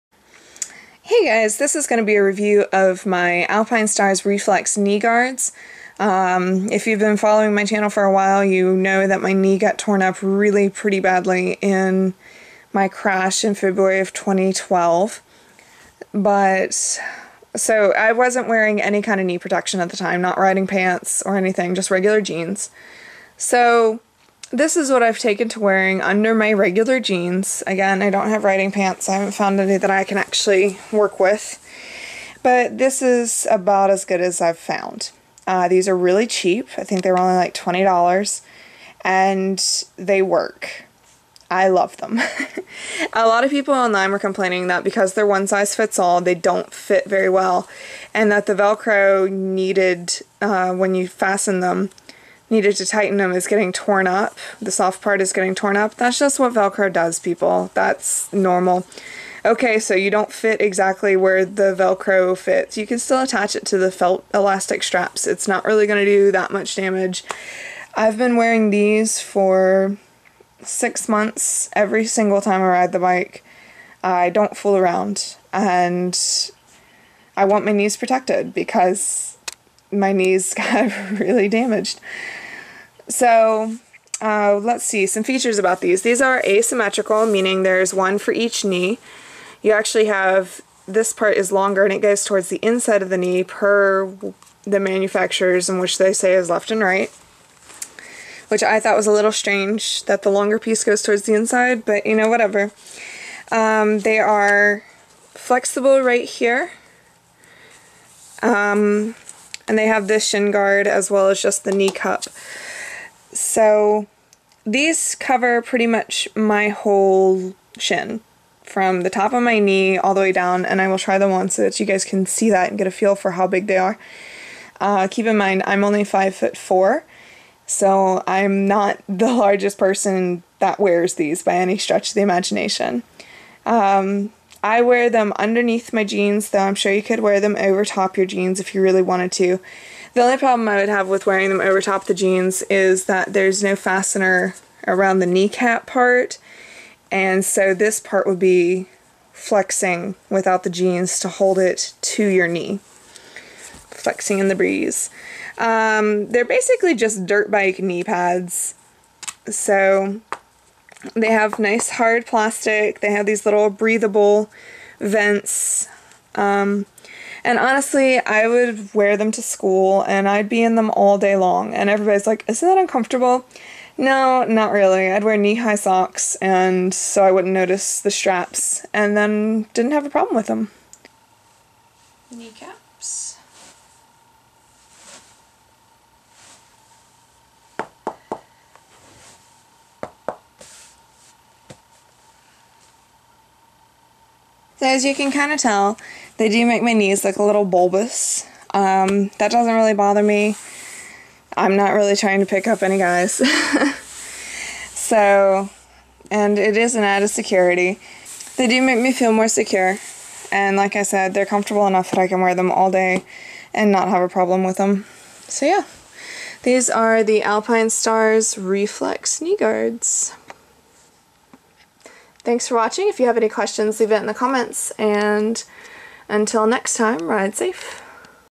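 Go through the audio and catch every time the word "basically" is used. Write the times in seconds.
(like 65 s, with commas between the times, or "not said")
156 s.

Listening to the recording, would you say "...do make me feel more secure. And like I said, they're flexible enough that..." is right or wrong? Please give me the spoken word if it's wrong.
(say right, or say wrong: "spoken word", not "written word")
wrong: "comfortable", not "flexible".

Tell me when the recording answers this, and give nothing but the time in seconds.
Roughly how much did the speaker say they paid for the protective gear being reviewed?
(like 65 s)
37 s.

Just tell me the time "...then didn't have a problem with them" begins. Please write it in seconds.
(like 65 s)
179 s.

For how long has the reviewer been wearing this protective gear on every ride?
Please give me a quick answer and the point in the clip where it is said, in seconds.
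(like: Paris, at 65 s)
6 months, at 70 s.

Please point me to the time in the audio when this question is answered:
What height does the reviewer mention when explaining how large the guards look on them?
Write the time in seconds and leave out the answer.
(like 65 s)
126 s.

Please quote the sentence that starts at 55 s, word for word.
That's just what Velcro does, people.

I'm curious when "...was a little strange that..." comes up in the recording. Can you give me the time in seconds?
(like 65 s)
98 s.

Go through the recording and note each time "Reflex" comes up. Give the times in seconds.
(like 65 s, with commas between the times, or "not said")
4 s, 218 s.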